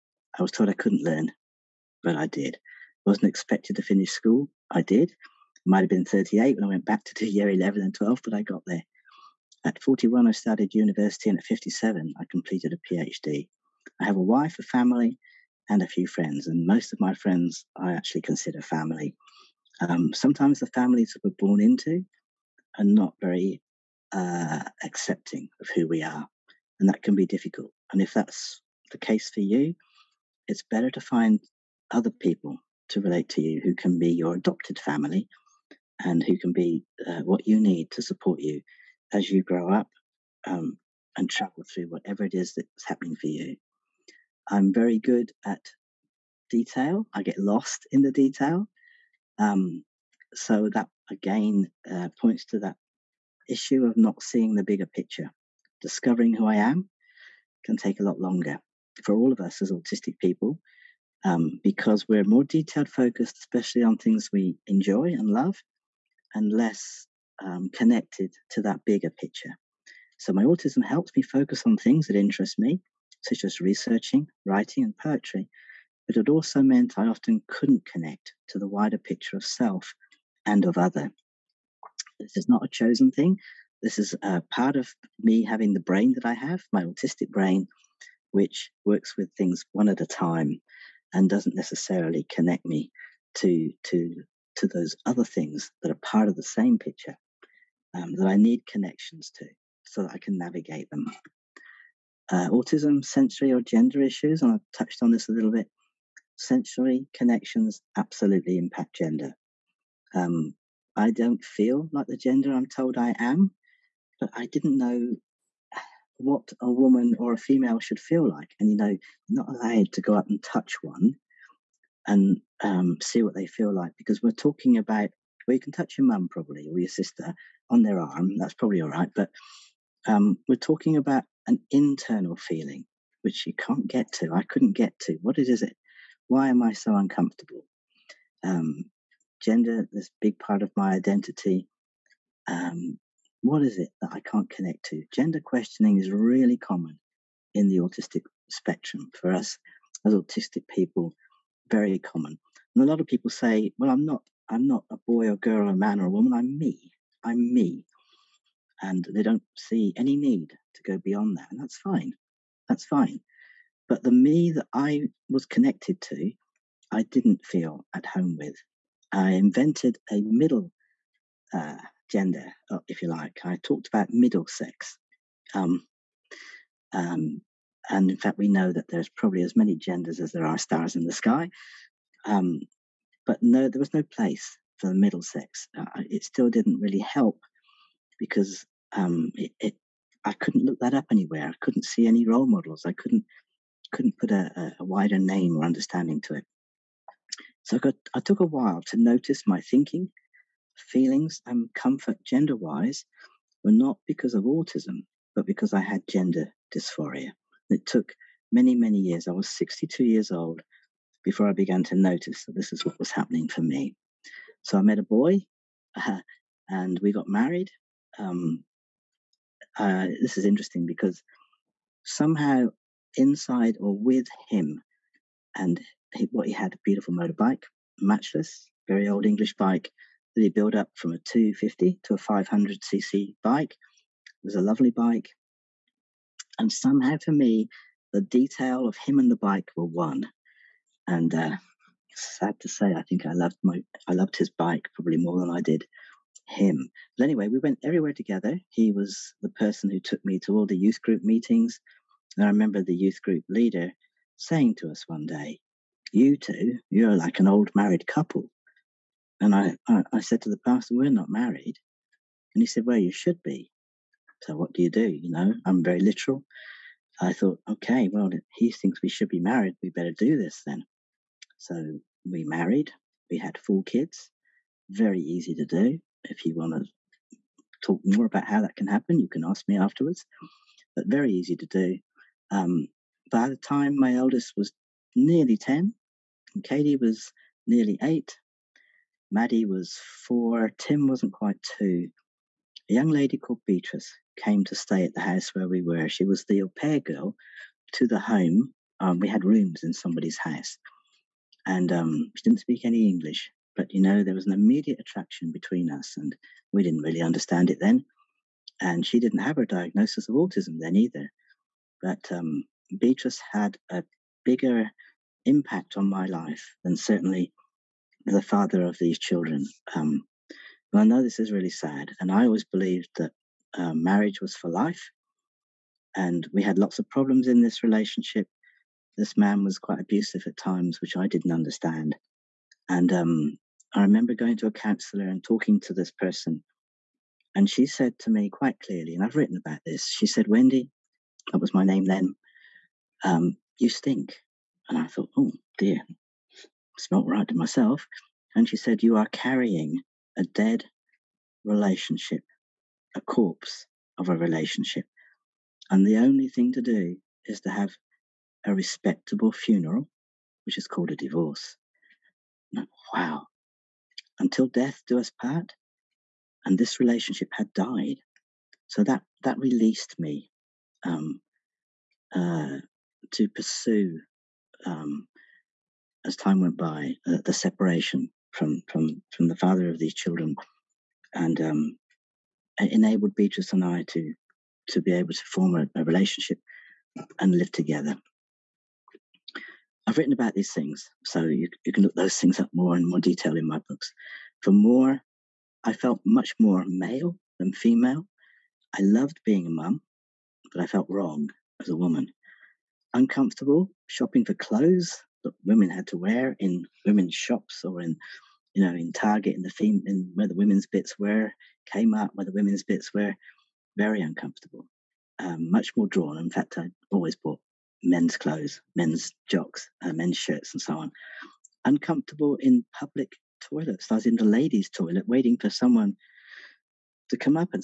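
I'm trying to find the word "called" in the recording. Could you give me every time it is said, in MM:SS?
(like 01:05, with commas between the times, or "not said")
04:53, 06:00.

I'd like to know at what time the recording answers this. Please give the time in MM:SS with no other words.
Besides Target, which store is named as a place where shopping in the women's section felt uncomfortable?
06:51.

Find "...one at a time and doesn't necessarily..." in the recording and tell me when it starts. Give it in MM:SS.
01:29.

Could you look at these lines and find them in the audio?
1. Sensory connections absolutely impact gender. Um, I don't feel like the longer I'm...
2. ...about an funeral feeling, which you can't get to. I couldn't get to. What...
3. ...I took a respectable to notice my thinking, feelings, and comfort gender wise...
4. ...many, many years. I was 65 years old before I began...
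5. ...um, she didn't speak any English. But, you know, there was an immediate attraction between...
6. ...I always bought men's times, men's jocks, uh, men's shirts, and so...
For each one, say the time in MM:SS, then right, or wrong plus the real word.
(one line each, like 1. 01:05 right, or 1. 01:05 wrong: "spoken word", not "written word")
1. 01:46 wrong: "gender", not "longer"
2. 02:10 wrong: "internal", not "funeral"
3. 03:18 wrong: "while", not "respectable"
4. 03:28 wrong: "62", not "65"
5. 05:01 right
6. 06:56 wrong: "clothes", not "times".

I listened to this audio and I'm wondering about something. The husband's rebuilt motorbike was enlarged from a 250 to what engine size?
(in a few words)
500cc.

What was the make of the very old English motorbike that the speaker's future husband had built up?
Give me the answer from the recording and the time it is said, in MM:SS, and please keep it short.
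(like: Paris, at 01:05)
Matchless, at 03:48.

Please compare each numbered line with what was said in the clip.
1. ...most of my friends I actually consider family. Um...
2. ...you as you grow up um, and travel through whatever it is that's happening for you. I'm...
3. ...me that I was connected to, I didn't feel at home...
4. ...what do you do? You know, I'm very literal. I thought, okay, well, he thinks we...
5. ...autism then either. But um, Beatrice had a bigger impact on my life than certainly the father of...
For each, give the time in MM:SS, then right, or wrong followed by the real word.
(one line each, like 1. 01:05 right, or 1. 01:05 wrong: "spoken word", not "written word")
1. 00:16 right
2. 00:38 right
3. 02:44 right
4. 04:24 right
5. 05:10 right.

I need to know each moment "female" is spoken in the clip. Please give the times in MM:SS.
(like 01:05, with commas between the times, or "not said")
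01:57, 06:37.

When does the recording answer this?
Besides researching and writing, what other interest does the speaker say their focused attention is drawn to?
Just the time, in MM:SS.
01:14.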